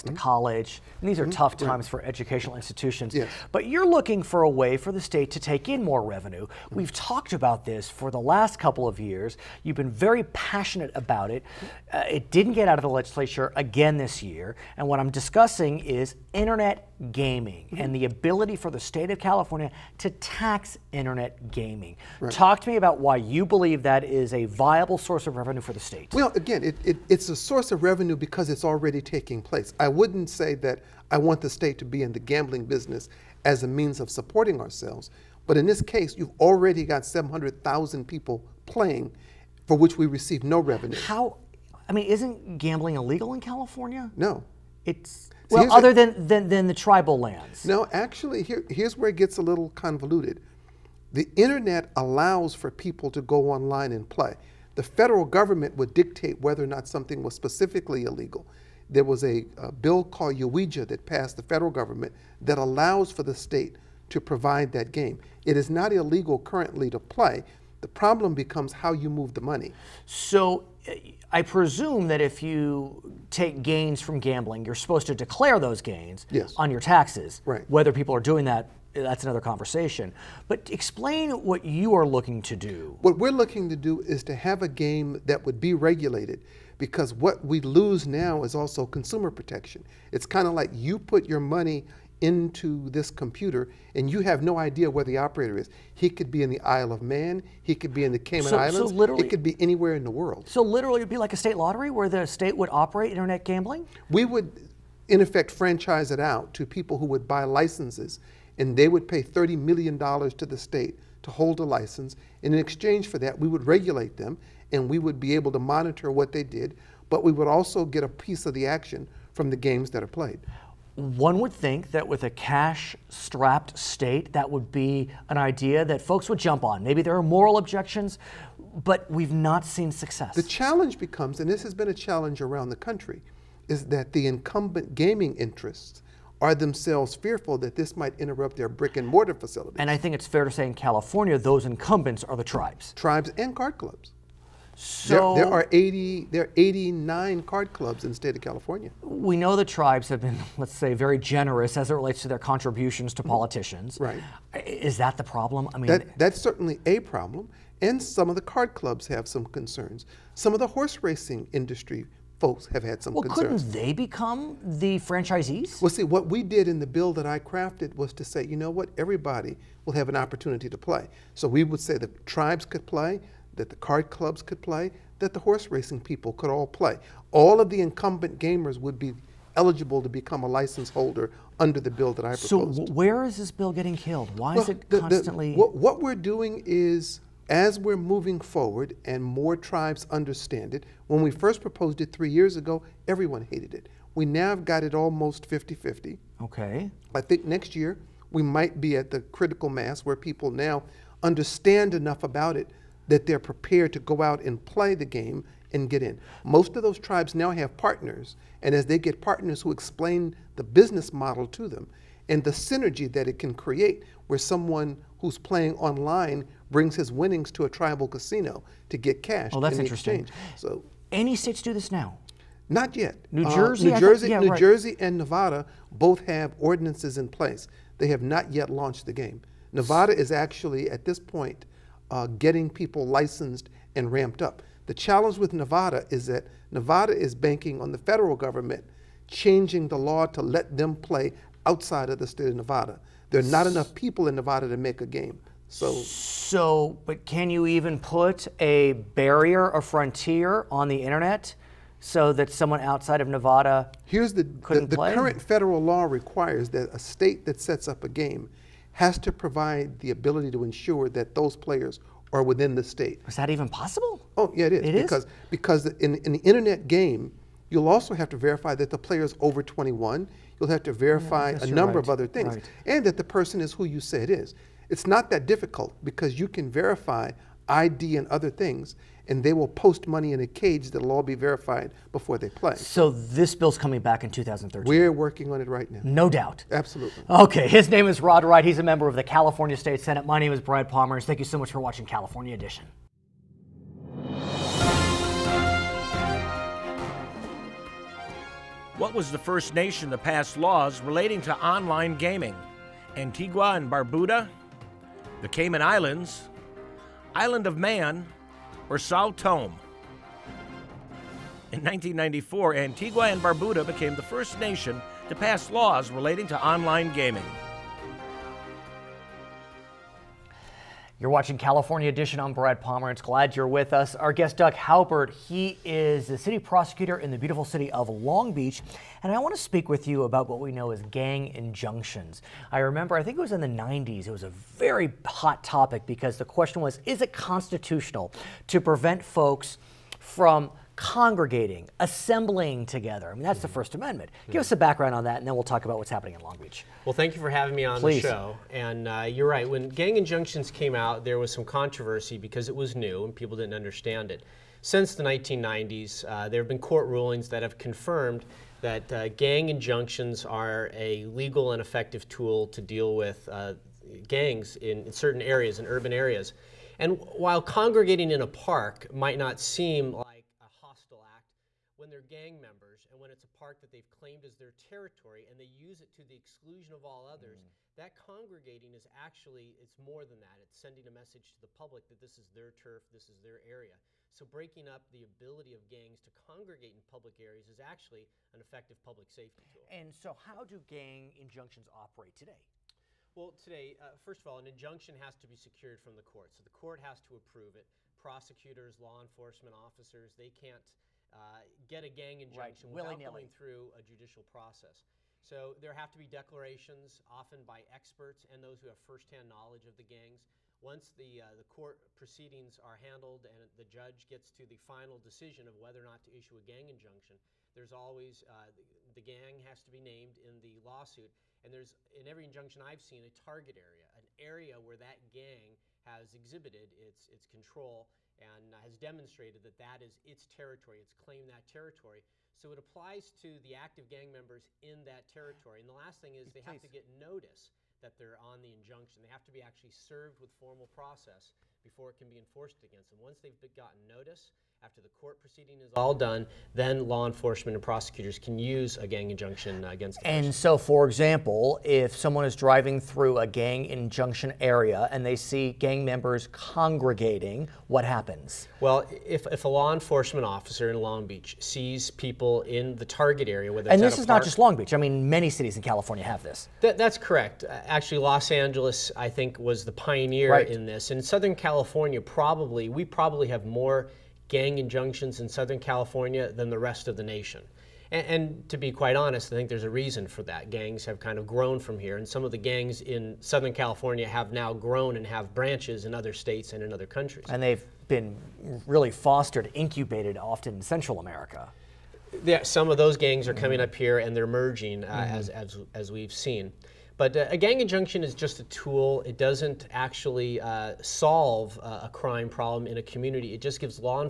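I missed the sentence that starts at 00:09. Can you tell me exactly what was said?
You've been very passionate about it.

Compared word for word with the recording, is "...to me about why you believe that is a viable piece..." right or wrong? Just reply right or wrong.
wrong.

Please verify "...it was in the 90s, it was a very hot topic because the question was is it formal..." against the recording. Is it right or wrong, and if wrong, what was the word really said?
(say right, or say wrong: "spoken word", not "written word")
wrong: "constitutional", not "formal".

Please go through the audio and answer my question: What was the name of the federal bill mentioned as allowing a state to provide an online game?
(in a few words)
UIGEA.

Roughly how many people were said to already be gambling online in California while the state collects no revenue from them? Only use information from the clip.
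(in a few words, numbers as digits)
700,000.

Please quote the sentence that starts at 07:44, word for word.
I mean, many cities in California have this.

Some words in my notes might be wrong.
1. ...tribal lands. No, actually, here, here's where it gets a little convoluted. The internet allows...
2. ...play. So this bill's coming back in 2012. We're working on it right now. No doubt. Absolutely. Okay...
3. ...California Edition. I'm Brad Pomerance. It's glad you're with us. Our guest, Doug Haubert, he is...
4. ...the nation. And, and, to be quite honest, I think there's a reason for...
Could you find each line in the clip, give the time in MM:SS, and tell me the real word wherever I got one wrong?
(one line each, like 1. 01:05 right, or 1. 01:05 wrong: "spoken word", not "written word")
1. 00:46 right
2. 04:42 wrong: "2013", not "2012"
3. 05:21 right
4. 07:57 right.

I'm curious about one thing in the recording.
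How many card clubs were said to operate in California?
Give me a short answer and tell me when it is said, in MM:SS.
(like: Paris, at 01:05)
89, at 02:26.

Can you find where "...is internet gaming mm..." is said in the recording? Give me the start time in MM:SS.
00:15.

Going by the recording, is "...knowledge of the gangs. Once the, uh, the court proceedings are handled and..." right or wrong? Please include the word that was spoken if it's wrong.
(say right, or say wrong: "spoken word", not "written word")
right.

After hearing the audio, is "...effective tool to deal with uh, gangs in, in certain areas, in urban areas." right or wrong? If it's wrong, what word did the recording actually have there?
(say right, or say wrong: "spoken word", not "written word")
right.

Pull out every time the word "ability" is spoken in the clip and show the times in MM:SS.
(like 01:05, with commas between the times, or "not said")
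00:18, 04:20, 06:25.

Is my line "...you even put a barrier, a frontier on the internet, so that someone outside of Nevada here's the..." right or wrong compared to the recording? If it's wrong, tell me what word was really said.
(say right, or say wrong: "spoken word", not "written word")
right.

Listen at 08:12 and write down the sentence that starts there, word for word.
Yeah, some of those gangs are coming mm-hmm.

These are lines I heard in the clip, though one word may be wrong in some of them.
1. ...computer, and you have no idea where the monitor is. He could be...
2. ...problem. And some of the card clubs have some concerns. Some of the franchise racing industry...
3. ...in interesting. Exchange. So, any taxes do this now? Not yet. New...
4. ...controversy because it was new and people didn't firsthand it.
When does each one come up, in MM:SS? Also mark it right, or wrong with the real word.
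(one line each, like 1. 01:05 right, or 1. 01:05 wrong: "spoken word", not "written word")
1. 01:33 wrong: "operator", not "monitor"
2. 02:36 wrong: "horse", not "franchise"
3. 03:39 wrong: "states", not "taxes"
4. 05:51 wrong: "understand", not "firsthand".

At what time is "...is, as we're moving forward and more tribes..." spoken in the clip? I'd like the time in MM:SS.
03:06.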